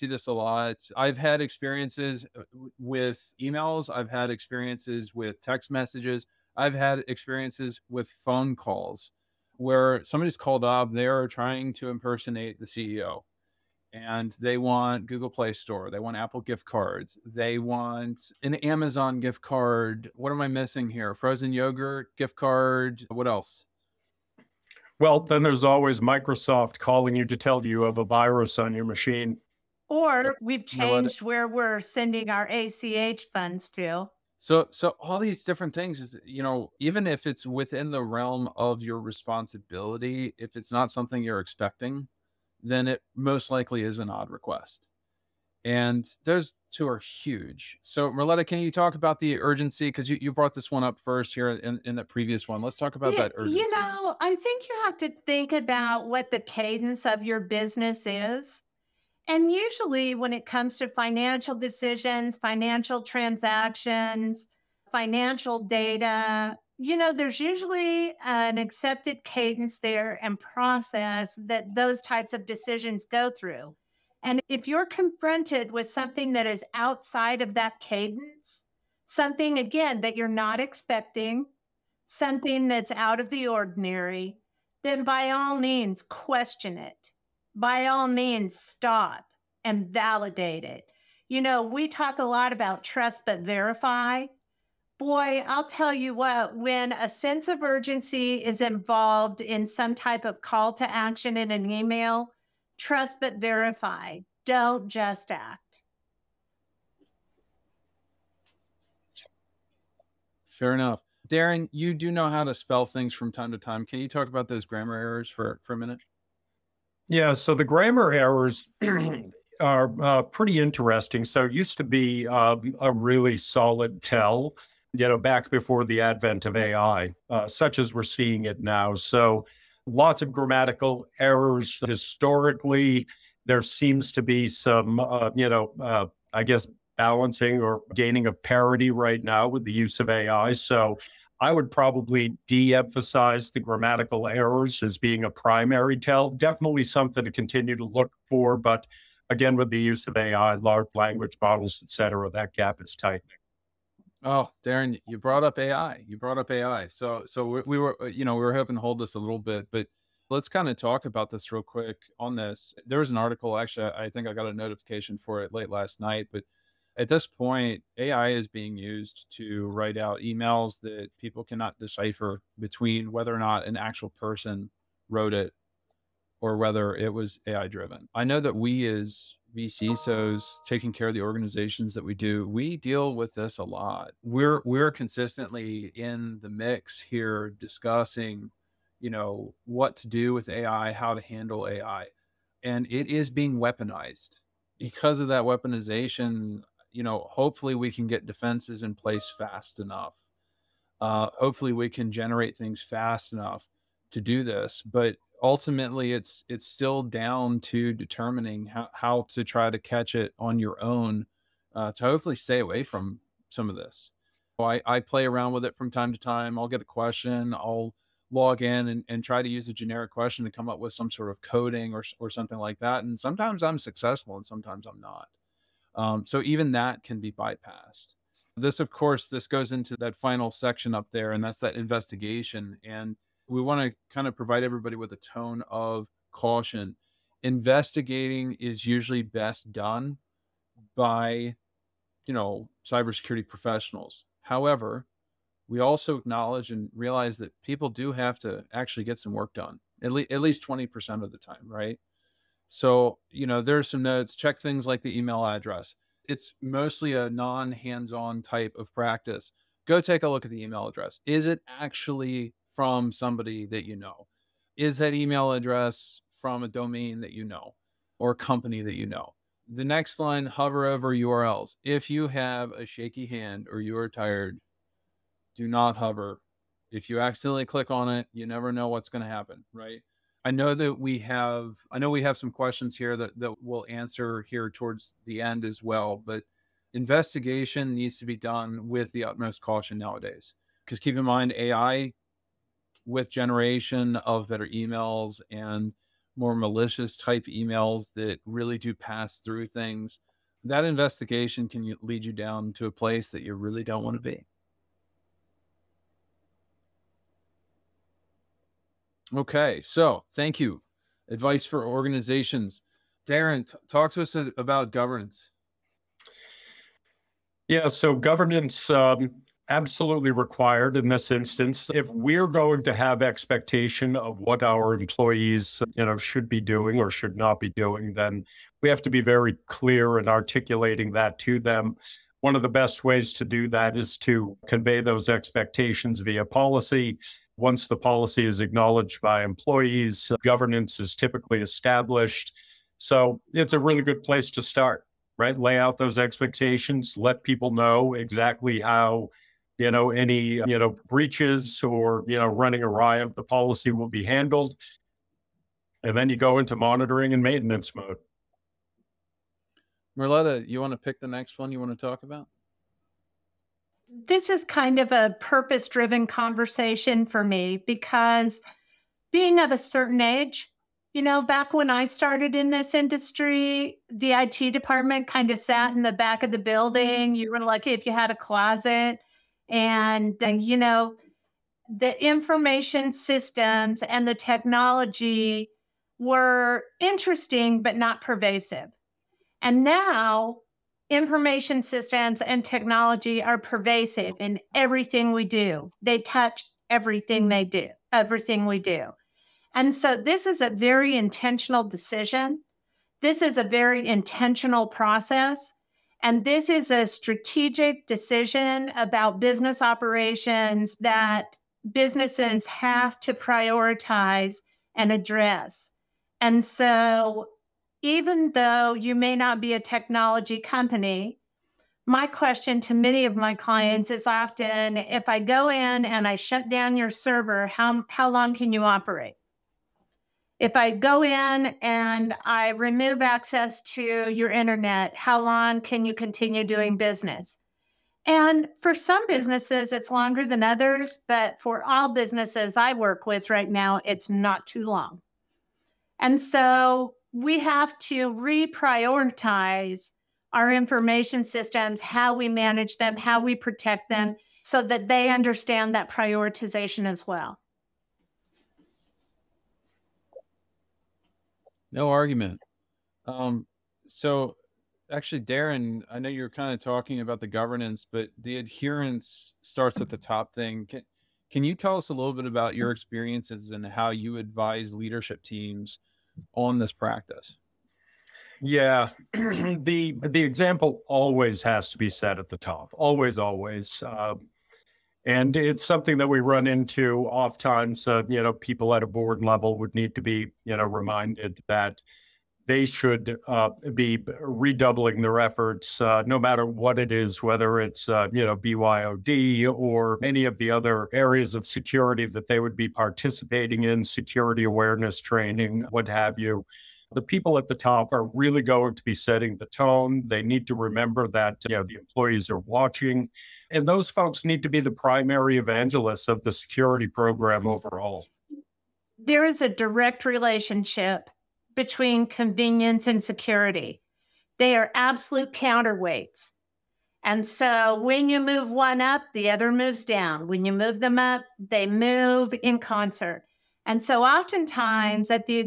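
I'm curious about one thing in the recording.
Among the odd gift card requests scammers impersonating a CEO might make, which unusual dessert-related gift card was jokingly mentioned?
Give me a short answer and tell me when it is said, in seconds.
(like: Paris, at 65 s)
Frozen yogurt gift card, at 21 s.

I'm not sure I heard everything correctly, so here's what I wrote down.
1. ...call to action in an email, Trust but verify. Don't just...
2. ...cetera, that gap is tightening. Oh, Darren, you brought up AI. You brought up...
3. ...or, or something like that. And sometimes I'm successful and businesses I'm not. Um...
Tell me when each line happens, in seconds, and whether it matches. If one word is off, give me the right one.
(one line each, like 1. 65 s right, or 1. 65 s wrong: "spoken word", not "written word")
1. 100 s right
2. 151 s right
3. 221 s wrong: "sometimes", not "businesses".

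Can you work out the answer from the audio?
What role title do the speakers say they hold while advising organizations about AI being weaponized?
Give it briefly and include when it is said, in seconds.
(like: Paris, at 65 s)
vCISOs, at 179 s.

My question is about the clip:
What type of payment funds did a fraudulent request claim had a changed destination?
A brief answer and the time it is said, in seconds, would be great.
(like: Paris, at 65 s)
ACH, at 32 s.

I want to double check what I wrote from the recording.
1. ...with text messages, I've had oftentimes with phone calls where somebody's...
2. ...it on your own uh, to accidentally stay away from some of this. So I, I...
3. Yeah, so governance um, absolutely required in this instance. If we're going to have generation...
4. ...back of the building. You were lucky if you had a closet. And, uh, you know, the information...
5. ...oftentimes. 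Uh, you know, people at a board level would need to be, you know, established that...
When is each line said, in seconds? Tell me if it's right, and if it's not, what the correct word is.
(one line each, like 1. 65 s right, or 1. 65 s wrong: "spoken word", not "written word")
1. 5 s wrong: "experiences", not "oftentimes"
2. 210 s wrong: "hopefully", not "accidentally"
3. 317 s wrong: "expectation", not "generation"
4. 376 s right
5. 487 s wrong: "reminded", not "established".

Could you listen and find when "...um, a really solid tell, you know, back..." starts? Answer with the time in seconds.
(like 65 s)
122 s.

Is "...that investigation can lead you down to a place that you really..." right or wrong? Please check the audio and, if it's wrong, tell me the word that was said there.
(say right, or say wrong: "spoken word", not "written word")
right.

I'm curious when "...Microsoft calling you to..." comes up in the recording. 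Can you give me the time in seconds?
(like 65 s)
26 s.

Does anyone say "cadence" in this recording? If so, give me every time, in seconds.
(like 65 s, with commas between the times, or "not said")
56 s, 69 s, 77 s.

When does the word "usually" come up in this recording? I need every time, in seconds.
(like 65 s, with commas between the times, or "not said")
59 s, 67 s, 238 s.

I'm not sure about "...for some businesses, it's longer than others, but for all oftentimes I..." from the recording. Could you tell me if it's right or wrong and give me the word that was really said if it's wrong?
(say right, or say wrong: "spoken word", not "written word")
wrong: "businesses", not "oftentimes".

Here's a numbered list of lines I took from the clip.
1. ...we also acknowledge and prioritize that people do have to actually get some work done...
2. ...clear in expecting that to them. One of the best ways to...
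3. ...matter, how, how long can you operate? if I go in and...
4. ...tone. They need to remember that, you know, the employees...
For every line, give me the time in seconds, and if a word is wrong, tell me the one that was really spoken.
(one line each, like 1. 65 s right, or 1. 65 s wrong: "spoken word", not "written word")
1. 245 s wrong: "realize", not "prioritize"
2. 329 s wrong: "articulating", not "expecting"
3. 427 s wrong: "server", not "matter"
4. 509 s right.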